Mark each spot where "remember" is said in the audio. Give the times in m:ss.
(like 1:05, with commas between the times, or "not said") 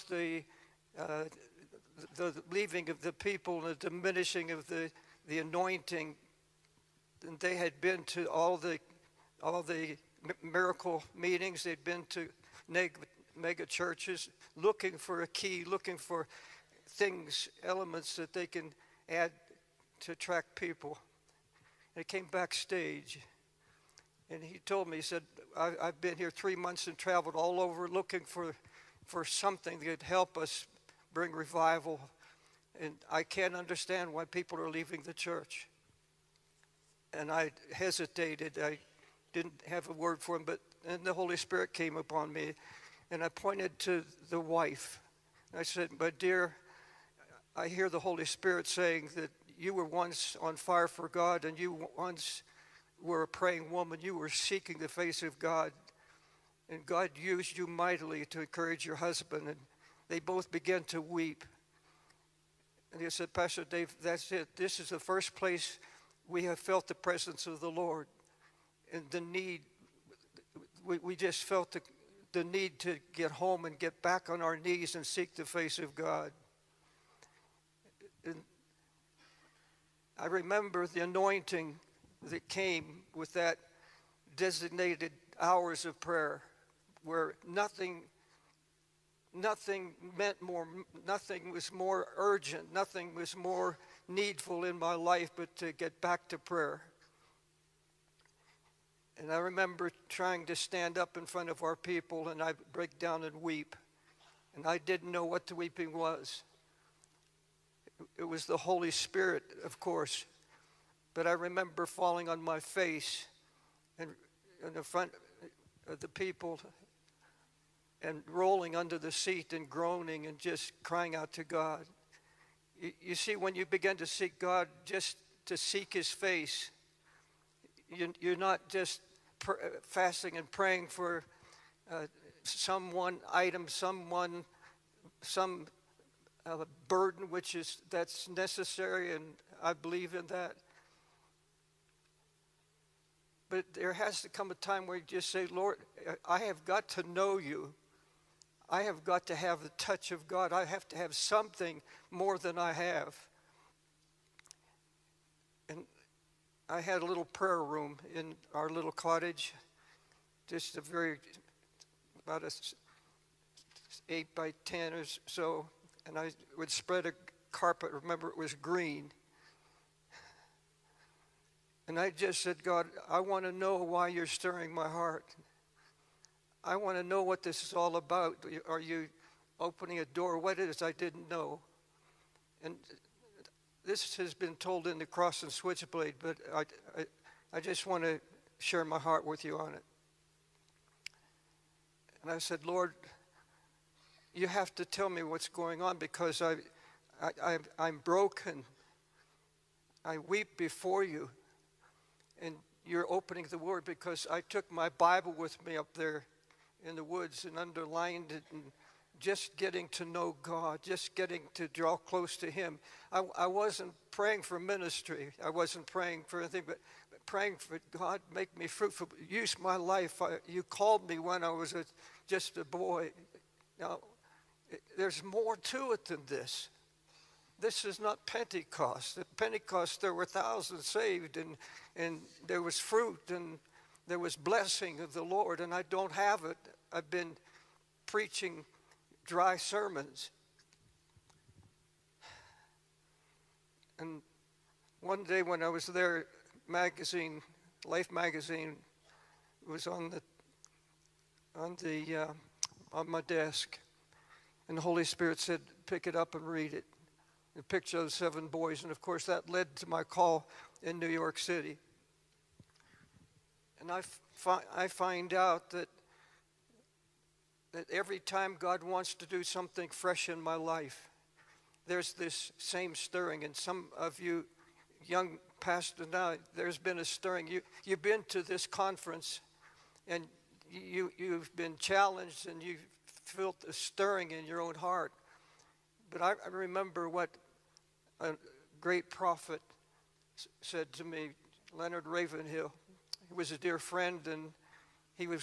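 1:20, 1:39, 1:51, 2:47, 4:46.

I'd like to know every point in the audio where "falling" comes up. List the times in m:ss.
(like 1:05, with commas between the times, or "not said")
1:51.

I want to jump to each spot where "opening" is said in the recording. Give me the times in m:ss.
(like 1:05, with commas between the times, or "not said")
2:59, 3:23.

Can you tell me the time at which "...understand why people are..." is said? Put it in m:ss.
0:33.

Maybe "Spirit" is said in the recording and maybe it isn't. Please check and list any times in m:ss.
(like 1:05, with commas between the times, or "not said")
0:41, 0:48, 1:48, 4:15.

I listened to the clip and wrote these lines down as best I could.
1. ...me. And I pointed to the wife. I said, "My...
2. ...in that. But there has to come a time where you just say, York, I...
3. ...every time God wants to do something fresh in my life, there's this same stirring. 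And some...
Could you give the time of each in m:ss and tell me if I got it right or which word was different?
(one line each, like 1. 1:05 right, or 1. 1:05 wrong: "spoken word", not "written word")
1. 0:42 right
2. 2:20 wrong: "Lord", not "York"
3. 4:27 right.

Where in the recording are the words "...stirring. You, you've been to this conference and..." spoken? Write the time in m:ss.
4:37.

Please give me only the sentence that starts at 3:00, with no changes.
What it is, I didn't know.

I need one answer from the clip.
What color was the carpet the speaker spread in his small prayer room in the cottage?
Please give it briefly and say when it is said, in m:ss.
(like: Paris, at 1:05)
Green, at 2:48.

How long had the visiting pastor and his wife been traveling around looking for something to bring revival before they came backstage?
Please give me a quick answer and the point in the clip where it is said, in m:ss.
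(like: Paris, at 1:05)
3 months, at 0:26.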